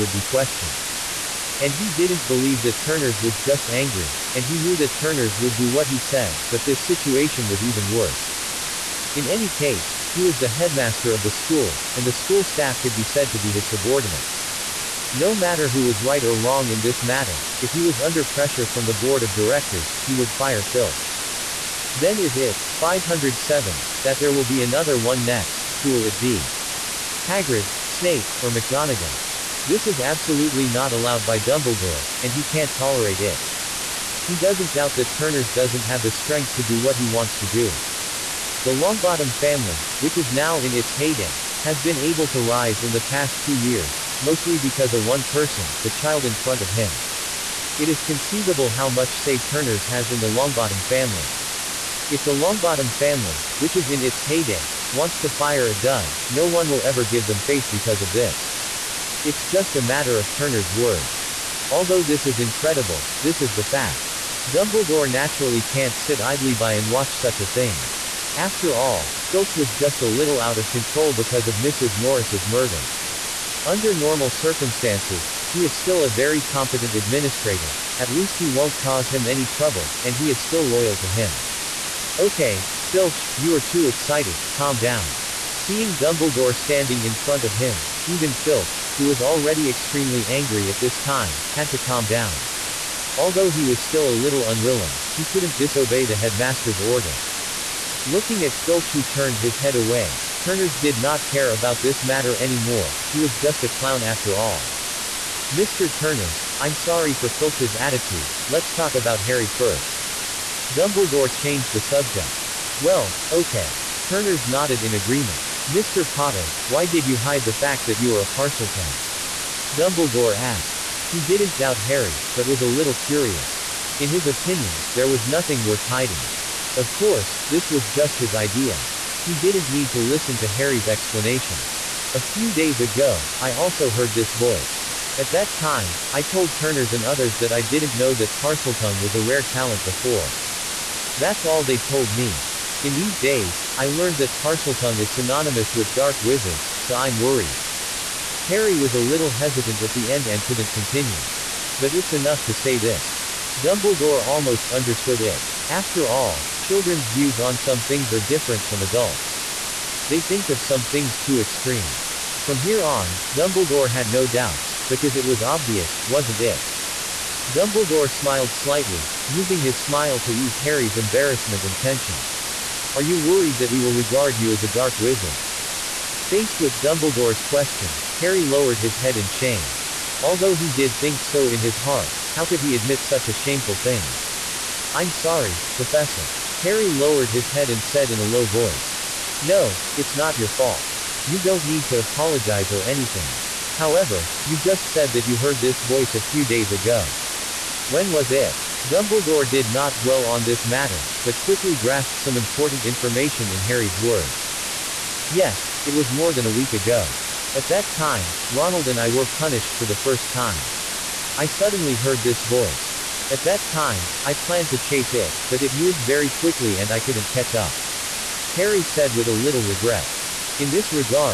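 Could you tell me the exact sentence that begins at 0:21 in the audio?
Then is it, 507, that there will be another one next, who will it be?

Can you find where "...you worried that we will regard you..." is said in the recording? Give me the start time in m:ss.
2:53.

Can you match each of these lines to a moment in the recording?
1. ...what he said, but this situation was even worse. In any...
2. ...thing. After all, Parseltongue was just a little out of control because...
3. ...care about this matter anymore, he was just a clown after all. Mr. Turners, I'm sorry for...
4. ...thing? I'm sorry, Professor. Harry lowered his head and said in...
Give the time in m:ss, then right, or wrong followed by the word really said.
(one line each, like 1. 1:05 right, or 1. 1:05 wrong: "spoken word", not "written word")
1. 0:05 right
2. 1:07 wrong: "Filch", not "Parseltongue"
3. 1:41 right
4. 3:03 right.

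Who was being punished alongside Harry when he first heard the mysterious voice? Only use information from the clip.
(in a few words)
Ronald.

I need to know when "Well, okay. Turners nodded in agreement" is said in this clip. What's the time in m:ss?
1:52.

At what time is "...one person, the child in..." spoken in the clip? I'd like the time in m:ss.
0:45.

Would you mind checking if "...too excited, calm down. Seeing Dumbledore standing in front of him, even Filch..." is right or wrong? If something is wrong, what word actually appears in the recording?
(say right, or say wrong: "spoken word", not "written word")
right.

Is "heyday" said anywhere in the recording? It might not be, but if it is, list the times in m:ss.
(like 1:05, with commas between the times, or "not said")
0:40, 0:54.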